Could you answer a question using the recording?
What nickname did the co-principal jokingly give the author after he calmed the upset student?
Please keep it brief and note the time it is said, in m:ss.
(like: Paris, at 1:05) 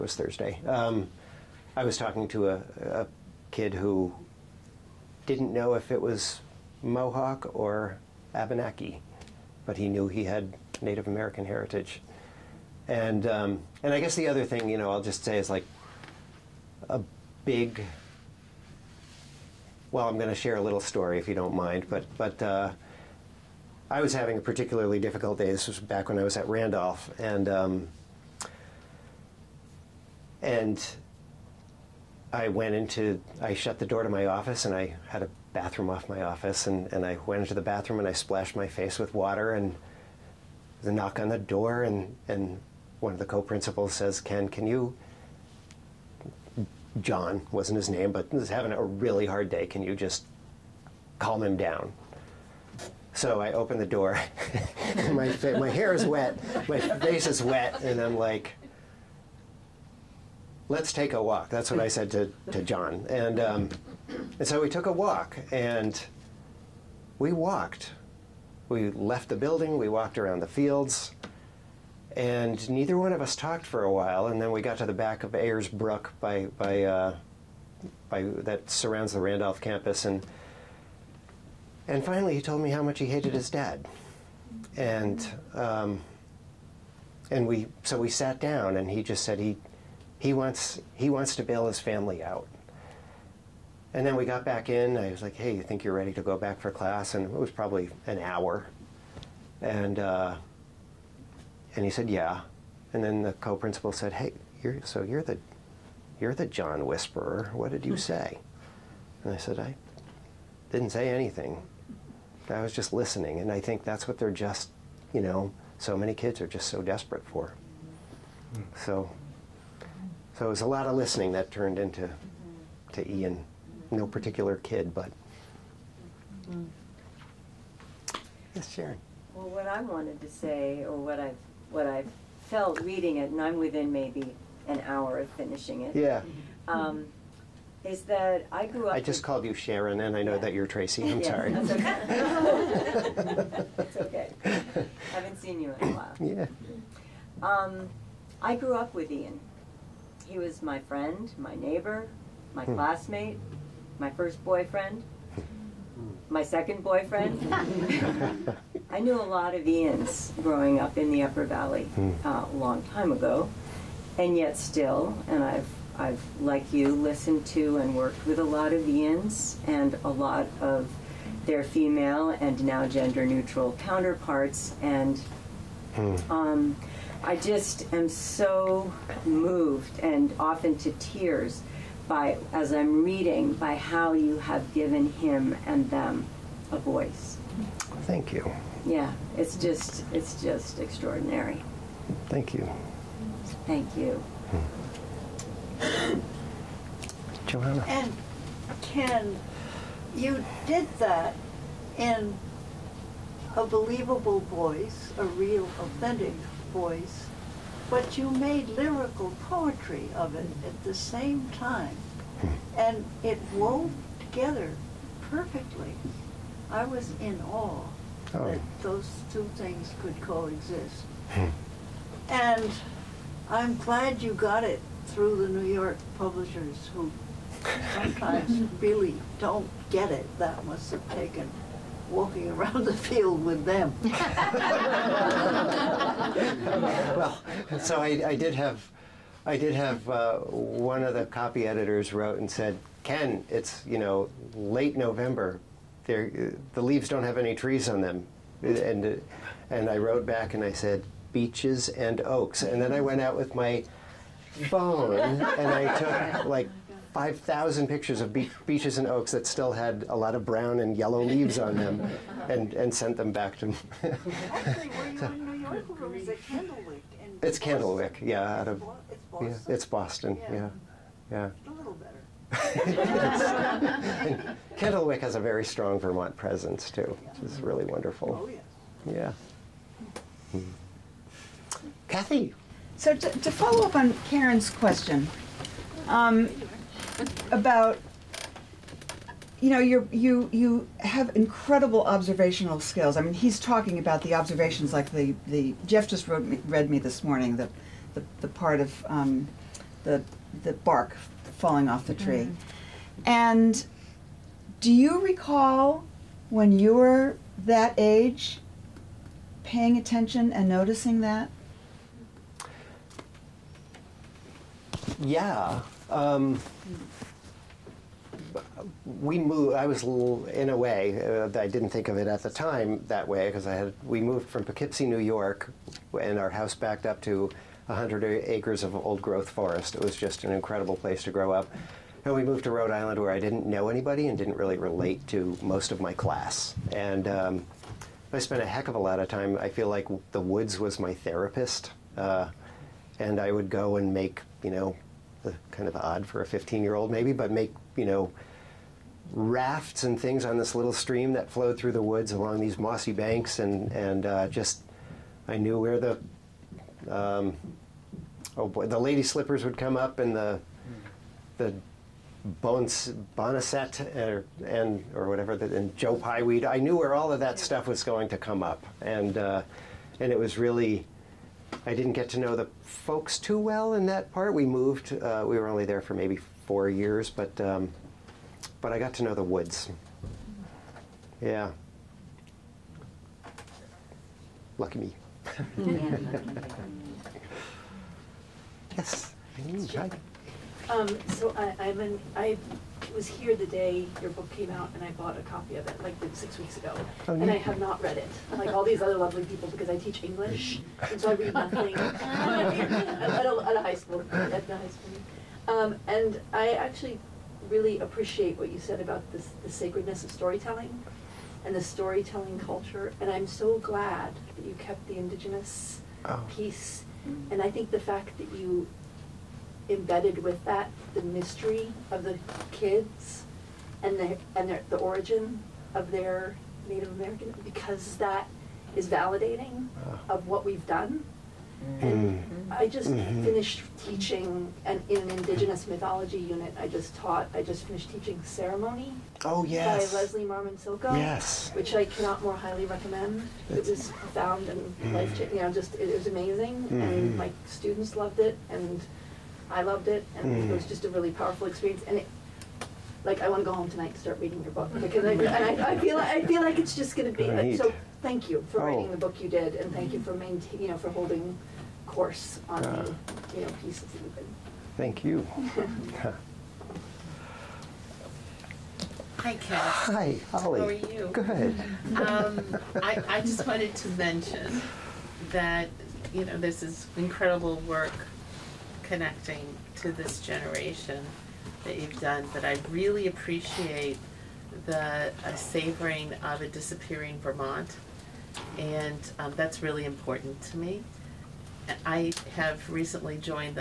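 the John Whisperer, at 1:46.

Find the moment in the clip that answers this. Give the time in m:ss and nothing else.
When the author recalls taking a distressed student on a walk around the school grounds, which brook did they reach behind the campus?
1:15.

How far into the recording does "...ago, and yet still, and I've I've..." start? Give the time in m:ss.
2:43.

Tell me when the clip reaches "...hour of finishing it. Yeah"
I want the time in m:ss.
2:14.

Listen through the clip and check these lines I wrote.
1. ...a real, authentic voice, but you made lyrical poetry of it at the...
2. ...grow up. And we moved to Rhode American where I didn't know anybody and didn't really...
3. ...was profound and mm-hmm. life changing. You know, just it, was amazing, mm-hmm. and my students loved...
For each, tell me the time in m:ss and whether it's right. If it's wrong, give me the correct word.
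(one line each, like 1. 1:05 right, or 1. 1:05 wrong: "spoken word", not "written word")
1. 3:25 right
2. 5:31 wrong: "Island", not "American"
3. 7:23 right.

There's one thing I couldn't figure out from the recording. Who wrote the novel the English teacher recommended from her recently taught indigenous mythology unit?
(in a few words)
Leslie Marmon Silko.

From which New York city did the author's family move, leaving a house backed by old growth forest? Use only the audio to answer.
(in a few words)
Poughkeepsie.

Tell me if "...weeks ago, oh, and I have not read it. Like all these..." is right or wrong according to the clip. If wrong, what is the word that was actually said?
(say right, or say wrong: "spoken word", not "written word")
right.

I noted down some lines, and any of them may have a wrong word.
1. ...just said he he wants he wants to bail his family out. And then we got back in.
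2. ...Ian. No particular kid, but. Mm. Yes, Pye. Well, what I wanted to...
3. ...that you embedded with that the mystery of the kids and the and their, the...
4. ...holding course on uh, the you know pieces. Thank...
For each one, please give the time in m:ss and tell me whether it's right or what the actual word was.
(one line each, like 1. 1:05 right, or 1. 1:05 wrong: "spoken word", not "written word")
1. 1:29 right
2. 2:03 wrong: "Sharon", not "Pye"
3. 6:58 right
4. 7:41 right.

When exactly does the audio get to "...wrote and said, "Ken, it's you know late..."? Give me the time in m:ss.
4:02.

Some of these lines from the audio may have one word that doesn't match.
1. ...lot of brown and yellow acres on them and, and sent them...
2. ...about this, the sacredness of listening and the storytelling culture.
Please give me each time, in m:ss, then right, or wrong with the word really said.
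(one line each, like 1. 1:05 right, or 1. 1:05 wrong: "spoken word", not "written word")
1. 4:20 wrong: "leaves", not "acres"
2. 6:48 wrong: "storytelling", not "listening".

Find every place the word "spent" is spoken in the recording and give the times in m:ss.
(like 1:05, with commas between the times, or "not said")
5:38.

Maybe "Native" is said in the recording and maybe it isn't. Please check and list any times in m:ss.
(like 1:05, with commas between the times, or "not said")
0:10, 7:06.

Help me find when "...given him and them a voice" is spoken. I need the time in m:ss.
3:04.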